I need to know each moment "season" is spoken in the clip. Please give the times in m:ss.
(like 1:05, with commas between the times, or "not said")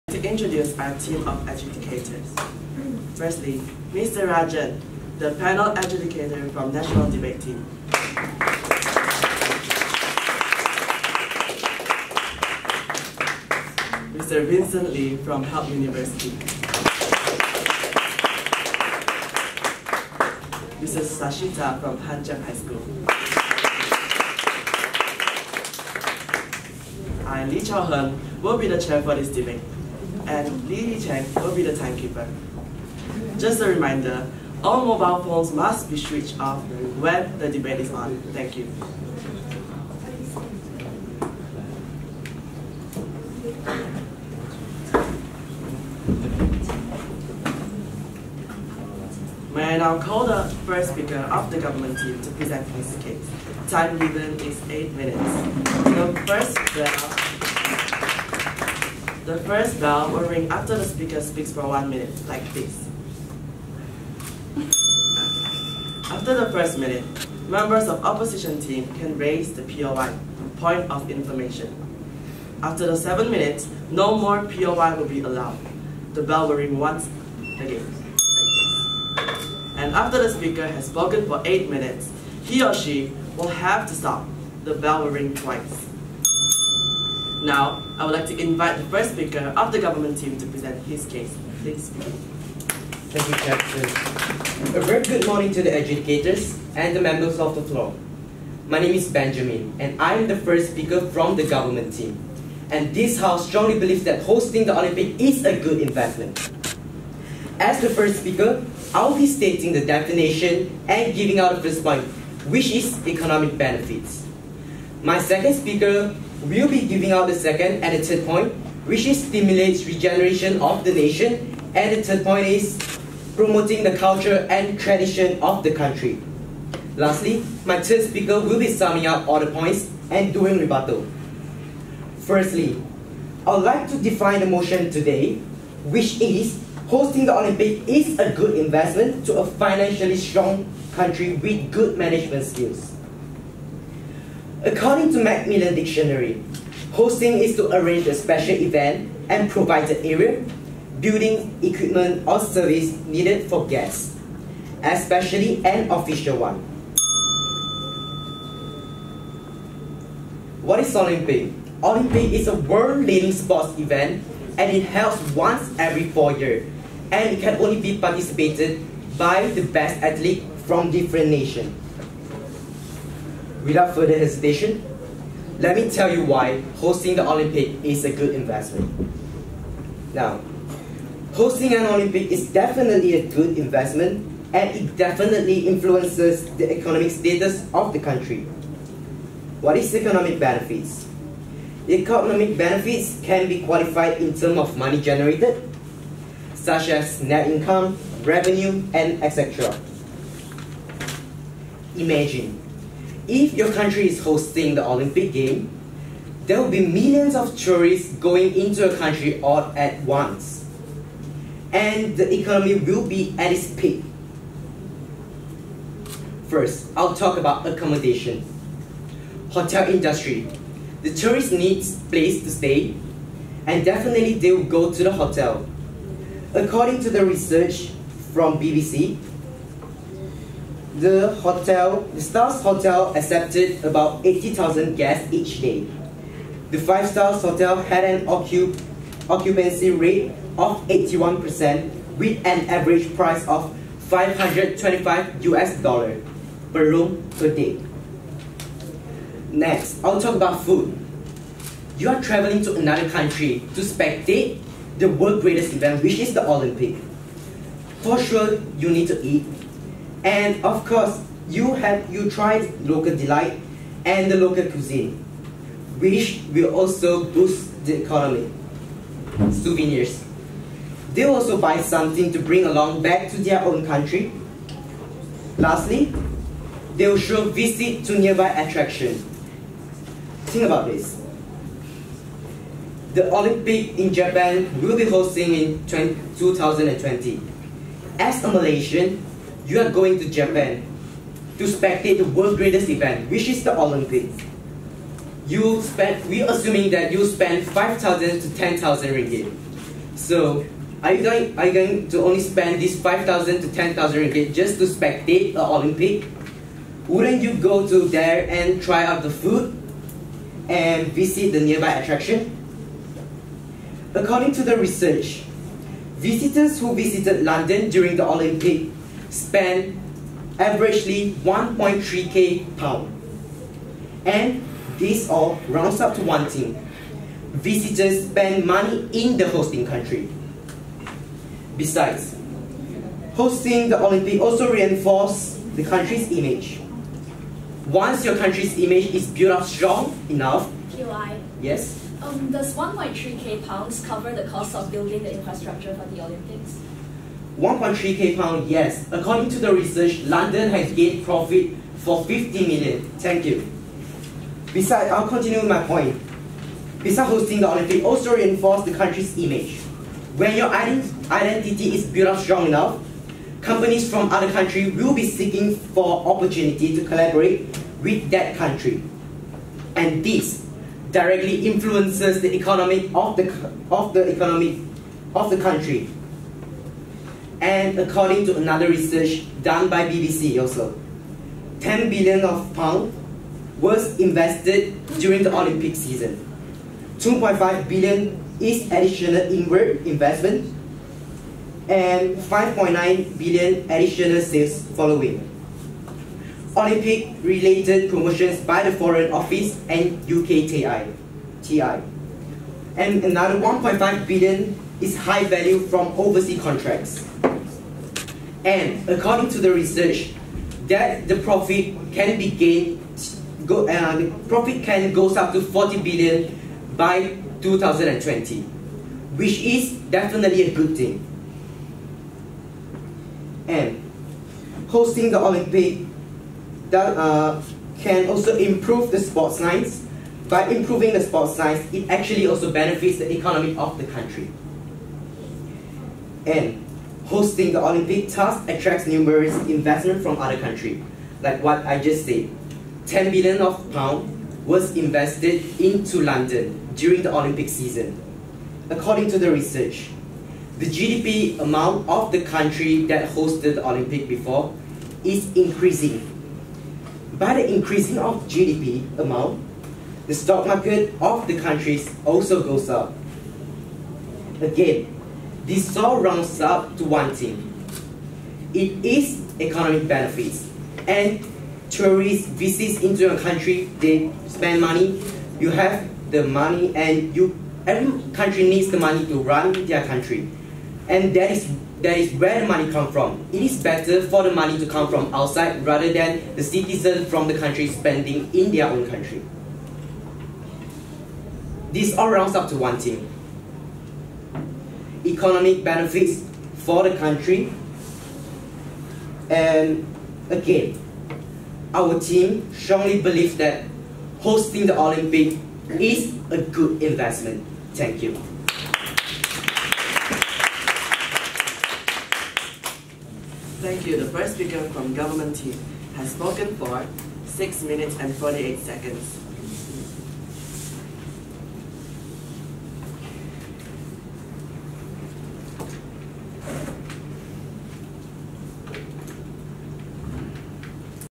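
6:25, 7:27.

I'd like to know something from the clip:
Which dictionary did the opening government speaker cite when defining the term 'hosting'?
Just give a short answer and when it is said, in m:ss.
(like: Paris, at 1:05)
Macmillan Dictionary, at 2:25.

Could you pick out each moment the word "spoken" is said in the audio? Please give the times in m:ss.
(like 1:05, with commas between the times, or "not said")
1:20, 8:36.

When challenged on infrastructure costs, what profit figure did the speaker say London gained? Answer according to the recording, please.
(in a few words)
50 million.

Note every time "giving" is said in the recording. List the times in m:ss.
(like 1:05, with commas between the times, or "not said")
1:51, 1:56.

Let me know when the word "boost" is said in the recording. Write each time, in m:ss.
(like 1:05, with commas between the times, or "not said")
4:27.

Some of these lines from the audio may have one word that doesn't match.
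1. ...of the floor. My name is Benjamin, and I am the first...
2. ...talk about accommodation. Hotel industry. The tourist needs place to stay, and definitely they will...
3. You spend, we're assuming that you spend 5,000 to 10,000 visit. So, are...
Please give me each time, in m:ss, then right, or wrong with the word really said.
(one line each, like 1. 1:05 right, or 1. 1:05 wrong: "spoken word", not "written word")
1. 1:37 right
2. 3:37 right
3. 4:55 wrong: "ringgit", not "visit".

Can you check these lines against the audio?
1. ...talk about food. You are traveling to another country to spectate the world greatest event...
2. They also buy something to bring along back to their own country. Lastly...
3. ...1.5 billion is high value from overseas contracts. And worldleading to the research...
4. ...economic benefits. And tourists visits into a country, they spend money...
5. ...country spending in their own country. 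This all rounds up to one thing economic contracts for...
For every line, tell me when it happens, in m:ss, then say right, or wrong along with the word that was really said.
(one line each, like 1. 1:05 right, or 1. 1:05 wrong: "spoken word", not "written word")
1. 4:10 right
2. 4:31 right
3. 6:43 wrong: "according", not "worldleading"
4. 7:49 right
5. 8:07 wrong: "benefits", not "contracts".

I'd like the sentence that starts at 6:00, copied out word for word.
When your identity is built up strong enough, companies from other countries will be seeking for opportunity to collaborate with that country.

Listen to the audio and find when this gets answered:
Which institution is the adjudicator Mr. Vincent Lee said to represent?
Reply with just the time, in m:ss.
0:15.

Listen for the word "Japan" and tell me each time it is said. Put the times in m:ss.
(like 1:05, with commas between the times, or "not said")
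4:44, 4:50.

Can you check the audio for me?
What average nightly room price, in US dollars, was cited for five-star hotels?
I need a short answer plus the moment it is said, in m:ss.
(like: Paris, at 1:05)
525 US dollars, at 4:04.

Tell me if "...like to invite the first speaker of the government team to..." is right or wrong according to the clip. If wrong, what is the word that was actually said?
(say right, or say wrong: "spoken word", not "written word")
right.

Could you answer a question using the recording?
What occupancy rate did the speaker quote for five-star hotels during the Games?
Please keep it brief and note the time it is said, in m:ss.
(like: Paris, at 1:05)
81%, at 4:00.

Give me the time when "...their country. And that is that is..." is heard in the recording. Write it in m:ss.
7:59.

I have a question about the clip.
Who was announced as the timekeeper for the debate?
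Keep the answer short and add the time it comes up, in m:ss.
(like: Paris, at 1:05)
Lily Cheng, at 0:30.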